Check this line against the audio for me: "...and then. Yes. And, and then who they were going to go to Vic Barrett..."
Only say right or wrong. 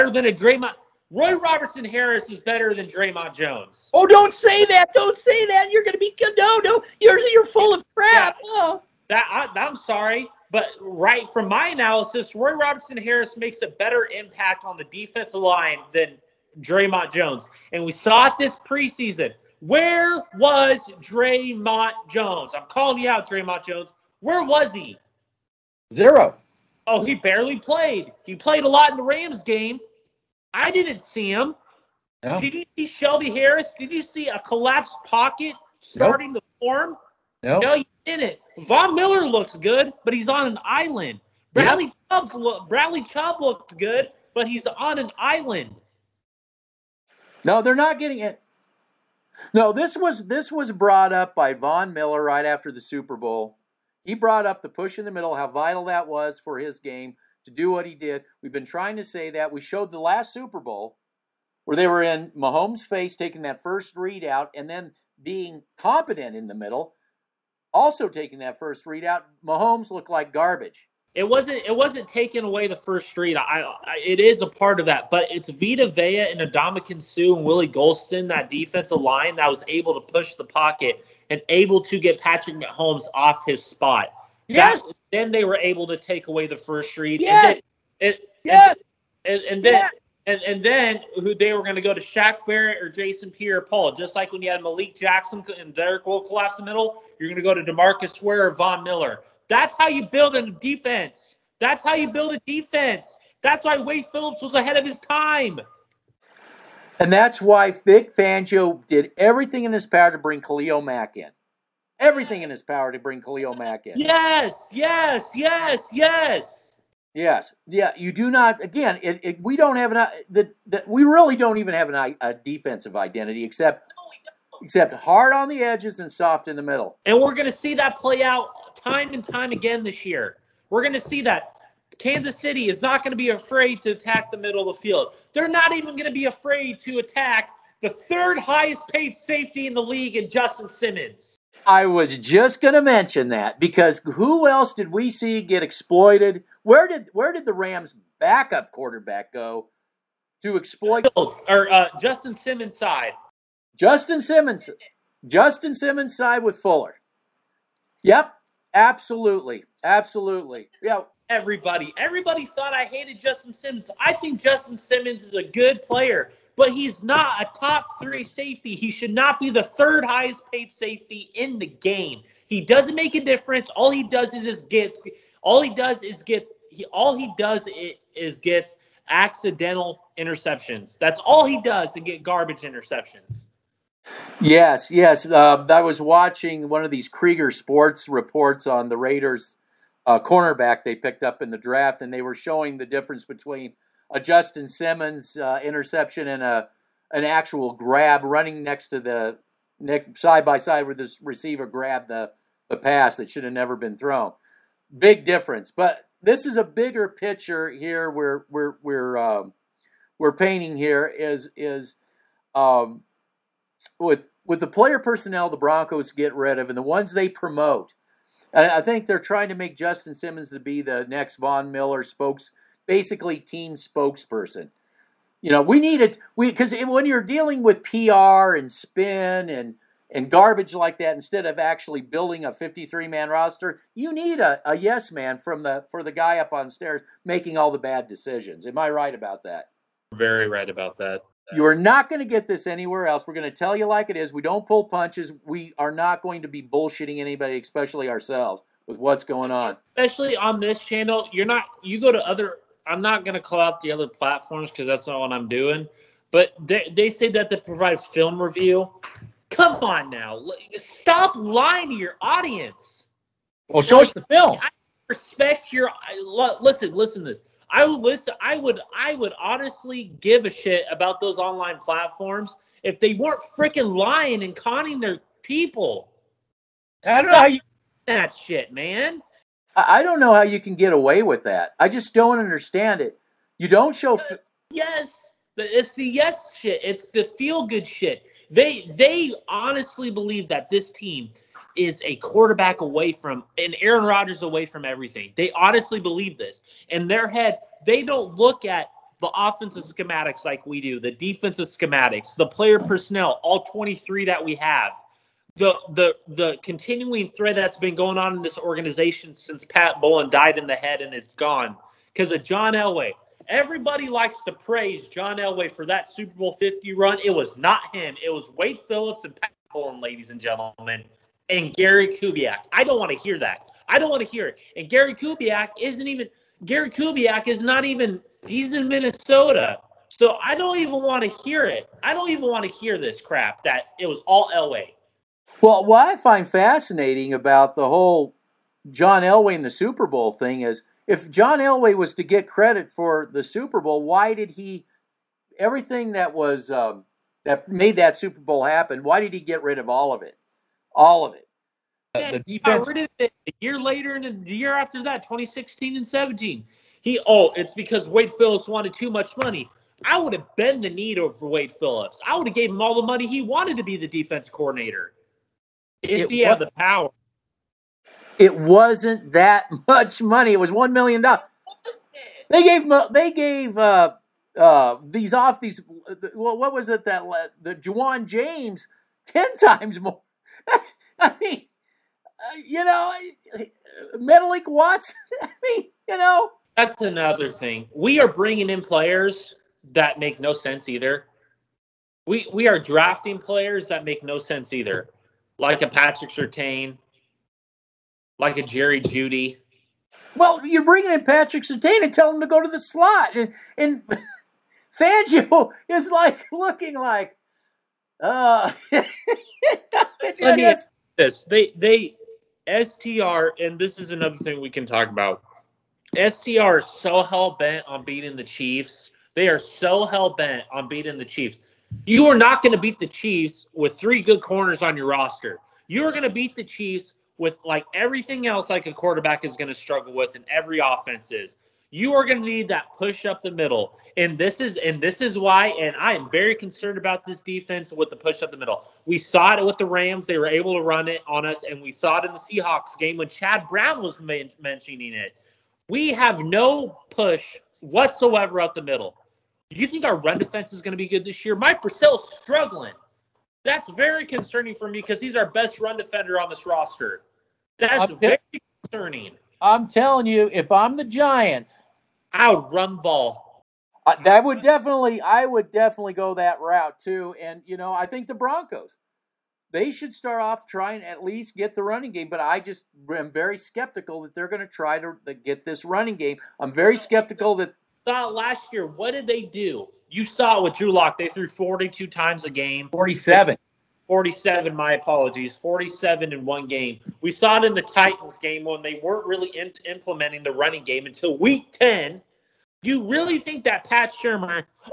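wrong.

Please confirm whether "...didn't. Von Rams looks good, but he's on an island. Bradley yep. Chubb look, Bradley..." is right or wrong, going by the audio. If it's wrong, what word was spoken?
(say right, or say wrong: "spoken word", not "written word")
wrong: "Miller", not "Rams".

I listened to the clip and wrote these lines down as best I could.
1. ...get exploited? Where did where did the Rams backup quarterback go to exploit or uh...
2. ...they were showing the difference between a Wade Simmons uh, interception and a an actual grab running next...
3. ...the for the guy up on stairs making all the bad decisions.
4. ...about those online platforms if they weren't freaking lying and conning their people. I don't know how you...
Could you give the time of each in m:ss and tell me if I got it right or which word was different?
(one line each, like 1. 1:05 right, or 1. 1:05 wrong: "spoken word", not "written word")
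1. 2:25 right
2. 3:12 wrong: "Justin", not "Wade"
3. 3:55 right
4. 4:30 right.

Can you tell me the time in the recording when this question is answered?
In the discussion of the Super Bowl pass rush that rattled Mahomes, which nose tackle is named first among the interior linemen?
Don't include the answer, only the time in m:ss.
1:15.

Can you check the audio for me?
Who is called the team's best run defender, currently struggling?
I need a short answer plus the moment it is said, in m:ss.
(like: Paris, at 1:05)
Mike Purcell, at 7:31.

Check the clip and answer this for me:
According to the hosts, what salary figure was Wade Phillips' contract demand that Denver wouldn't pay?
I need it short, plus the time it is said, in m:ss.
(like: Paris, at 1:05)
1 million dollars, at 6:10.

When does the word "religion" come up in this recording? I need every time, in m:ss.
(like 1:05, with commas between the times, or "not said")
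not said.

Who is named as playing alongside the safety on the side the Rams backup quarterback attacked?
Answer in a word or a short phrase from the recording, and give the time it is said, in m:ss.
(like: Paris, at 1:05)
Fuller, at 2:36.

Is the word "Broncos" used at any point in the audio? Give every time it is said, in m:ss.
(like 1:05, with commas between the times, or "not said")
3:35, 7:48.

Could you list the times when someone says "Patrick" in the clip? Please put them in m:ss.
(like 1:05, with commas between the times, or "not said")
1:22, 6:35, 6:41.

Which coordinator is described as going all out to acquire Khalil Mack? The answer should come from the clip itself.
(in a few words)
Vic Fangio.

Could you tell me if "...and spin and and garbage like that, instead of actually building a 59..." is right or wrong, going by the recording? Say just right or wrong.
wrong.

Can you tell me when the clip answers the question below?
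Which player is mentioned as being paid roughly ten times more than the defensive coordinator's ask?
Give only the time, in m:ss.
6:17.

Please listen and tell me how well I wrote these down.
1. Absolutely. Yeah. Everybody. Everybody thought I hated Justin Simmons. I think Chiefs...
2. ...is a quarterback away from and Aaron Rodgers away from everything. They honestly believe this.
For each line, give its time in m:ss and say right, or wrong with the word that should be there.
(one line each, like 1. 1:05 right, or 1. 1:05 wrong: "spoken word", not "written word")
1. 2:39 wrong: "Justin", not "Chiefs"
2. 4:51 right.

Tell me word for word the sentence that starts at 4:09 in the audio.
Especially on this channel, you're not.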